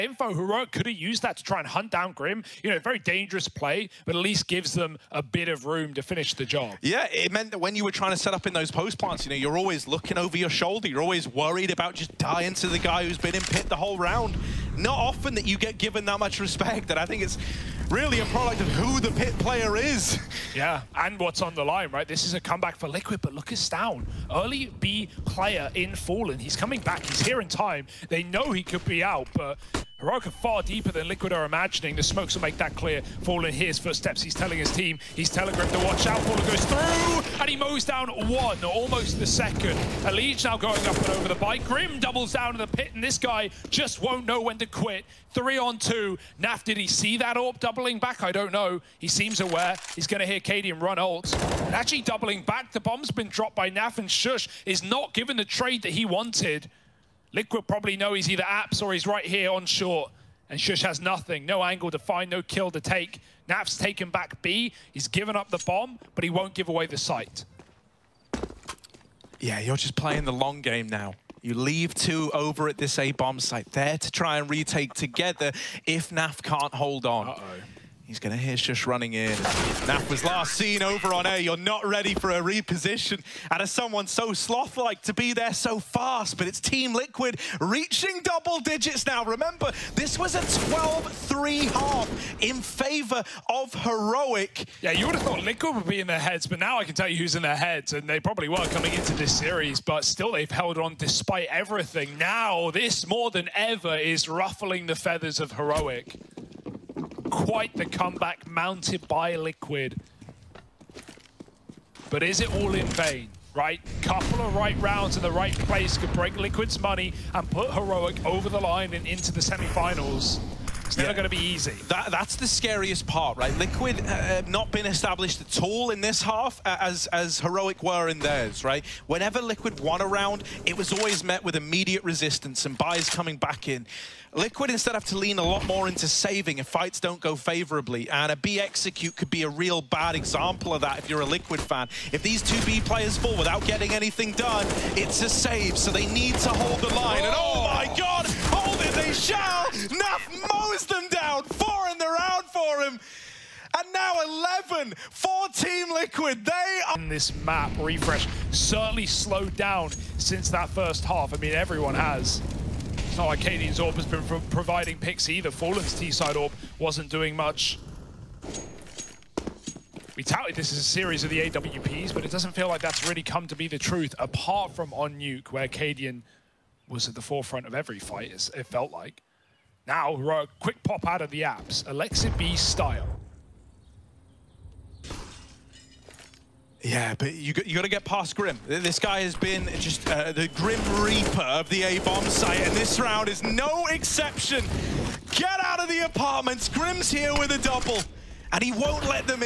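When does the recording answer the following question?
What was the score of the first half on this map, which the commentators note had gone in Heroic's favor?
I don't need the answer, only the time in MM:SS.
01:30.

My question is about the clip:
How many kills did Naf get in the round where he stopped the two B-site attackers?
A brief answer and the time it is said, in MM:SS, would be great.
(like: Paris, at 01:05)
4, at 02:31.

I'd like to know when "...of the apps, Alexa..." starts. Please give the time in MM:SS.
03:01.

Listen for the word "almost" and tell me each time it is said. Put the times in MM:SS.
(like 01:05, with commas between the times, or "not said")
00:38.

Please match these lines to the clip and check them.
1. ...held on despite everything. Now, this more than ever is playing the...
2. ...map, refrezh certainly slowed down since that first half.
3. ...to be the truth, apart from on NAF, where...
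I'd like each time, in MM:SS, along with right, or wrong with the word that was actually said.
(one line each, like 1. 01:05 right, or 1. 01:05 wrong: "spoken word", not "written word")
1. 01:40 wrong: "ruffling", not "playing"
2. 02:37 right
3. 02:53 wrong: "Nuke", not "NAF".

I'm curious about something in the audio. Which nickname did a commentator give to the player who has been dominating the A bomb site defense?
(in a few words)
the Grim Reaper.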